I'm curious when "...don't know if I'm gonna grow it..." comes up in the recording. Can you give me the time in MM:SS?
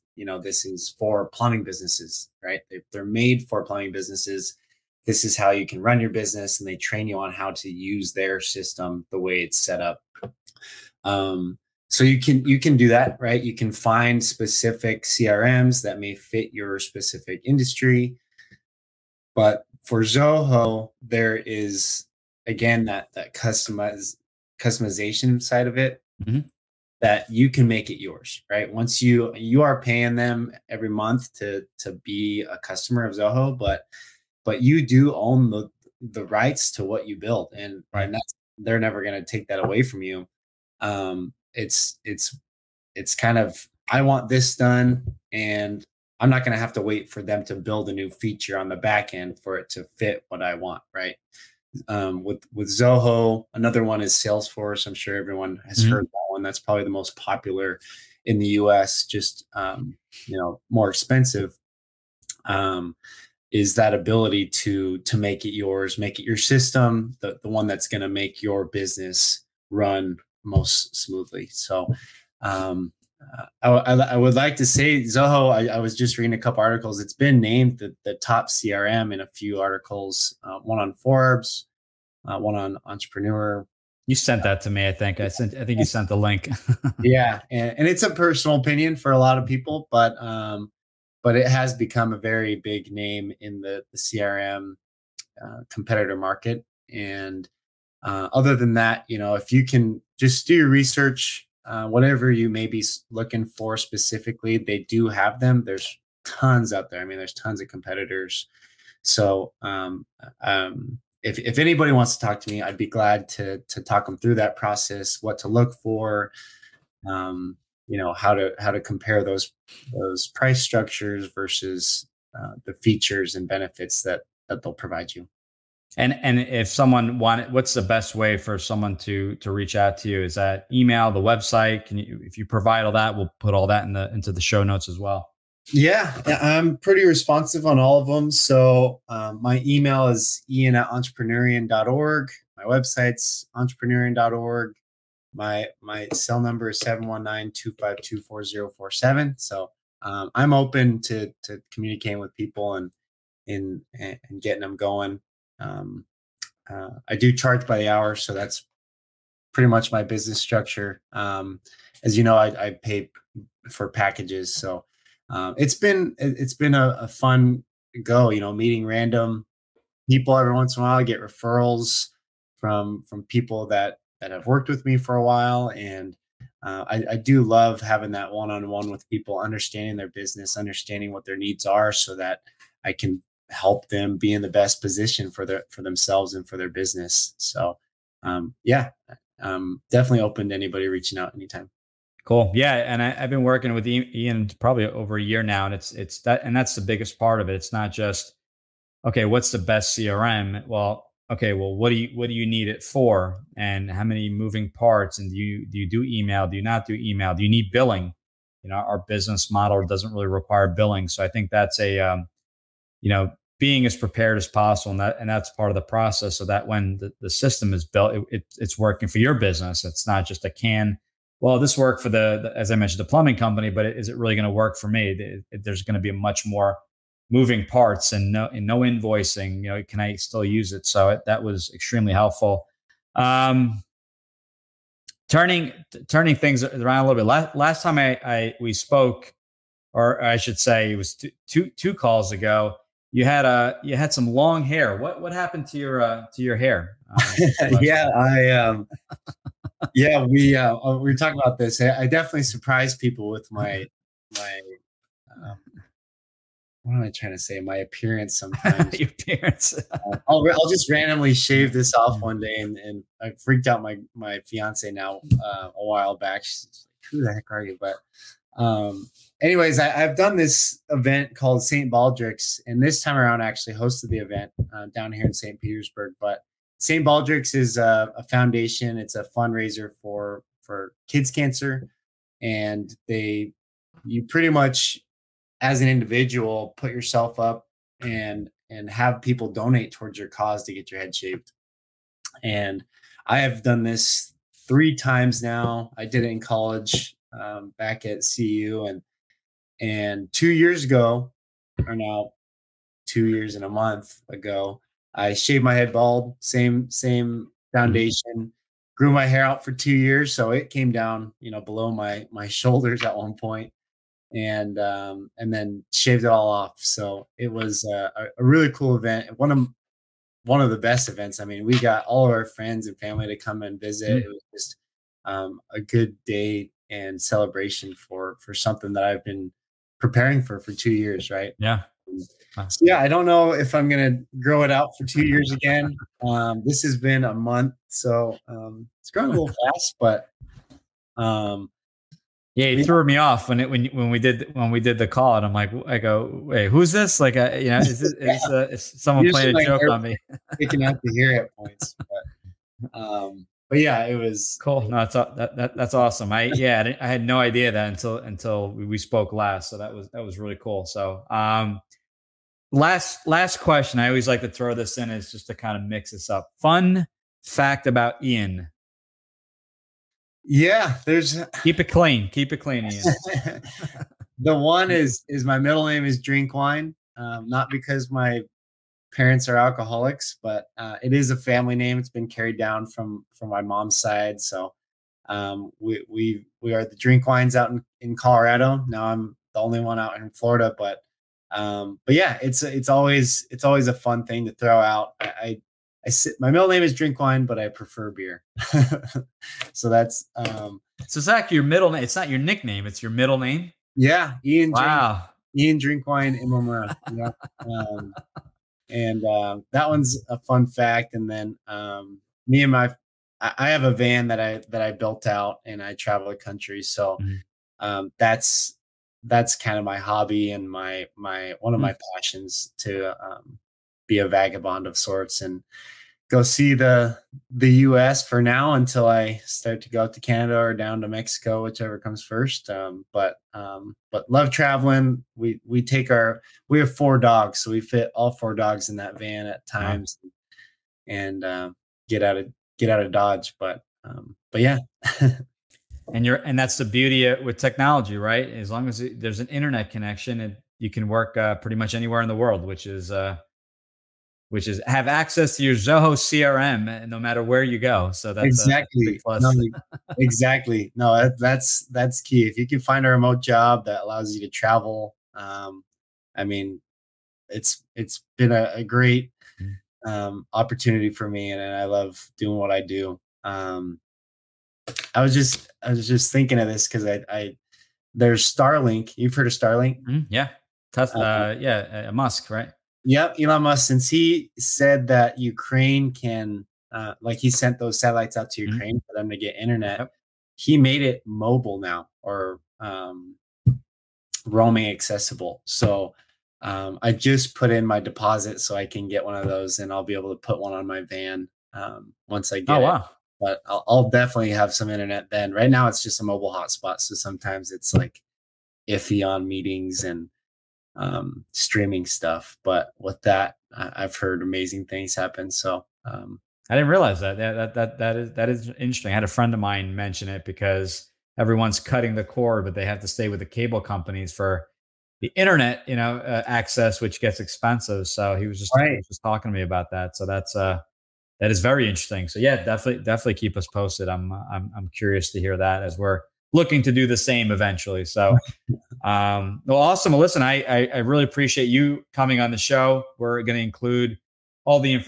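05:33.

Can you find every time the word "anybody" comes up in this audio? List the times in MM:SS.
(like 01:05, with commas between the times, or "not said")
01:51, 03:10.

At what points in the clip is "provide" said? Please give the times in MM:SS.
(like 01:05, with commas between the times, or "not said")
02:04, 02:12.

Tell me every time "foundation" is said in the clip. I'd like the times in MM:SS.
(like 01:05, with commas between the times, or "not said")
04:38, 05:07.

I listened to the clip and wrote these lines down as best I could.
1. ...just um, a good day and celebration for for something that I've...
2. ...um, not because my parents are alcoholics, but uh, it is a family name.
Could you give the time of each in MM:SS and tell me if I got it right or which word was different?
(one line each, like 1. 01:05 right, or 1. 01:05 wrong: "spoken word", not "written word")
1. 05:24 right
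2. 06:17 right.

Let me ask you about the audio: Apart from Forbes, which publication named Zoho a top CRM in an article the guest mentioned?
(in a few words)
Entrepreneur.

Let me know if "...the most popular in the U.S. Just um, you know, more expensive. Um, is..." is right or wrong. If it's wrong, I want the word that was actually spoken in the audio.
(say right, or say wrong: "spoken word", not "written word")
right.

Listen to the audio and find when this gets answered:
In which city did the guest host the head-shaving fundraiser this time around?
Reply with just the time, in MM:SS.
04:35.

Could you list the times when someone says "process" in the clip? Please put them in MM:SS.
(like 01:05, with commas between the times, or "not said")
01:54, 03:35.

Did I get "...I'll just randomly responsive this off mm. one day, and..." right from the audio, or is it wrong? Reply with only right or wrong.
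wrong.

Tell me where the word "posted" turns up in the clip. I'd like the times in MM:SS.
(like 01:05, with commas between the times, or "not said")
08:53.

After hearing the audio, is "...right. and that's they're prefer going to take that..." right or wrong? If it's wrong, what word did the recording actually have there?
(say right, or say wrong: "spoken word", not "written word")
wrong: "never", not "prefer".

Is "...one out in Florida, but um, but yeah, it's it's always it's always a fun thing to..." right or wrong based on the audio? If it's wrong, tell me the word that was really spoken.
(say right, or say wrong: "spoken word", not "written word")
right.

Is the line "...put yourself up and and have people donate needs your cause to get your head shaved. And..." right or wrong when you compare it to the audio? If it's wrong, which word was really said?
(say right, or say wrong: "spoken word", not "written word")
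wrong: "towards", not "needs".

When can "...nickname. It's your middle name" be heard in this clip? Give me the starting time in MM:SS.
06:42.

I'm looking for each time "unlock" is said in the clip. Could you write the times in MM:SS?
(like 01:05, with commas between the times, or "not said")
not said.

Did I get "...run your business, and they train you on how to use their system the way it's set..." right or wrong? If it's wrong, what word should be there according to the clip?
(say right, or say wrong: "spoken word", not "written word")
right.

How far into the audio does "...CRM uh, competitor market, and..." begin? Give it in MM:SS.
01:33.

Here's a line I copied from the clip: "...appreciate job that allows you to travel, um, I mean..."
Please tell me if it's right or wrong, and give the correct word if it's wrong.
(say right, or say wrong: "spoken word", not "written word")
wrong: "remote", not "appreciate".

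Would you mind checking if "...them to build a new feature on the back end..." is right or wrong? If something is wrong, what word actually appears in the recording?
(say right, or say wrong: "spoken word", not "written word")
right.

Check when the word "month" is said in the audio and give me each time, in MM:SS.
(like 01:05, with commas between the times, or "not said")
00:30, 05:03, 05:37.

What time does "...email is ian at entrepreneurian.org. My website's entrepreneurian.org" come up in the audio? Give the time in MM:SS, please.
02:19.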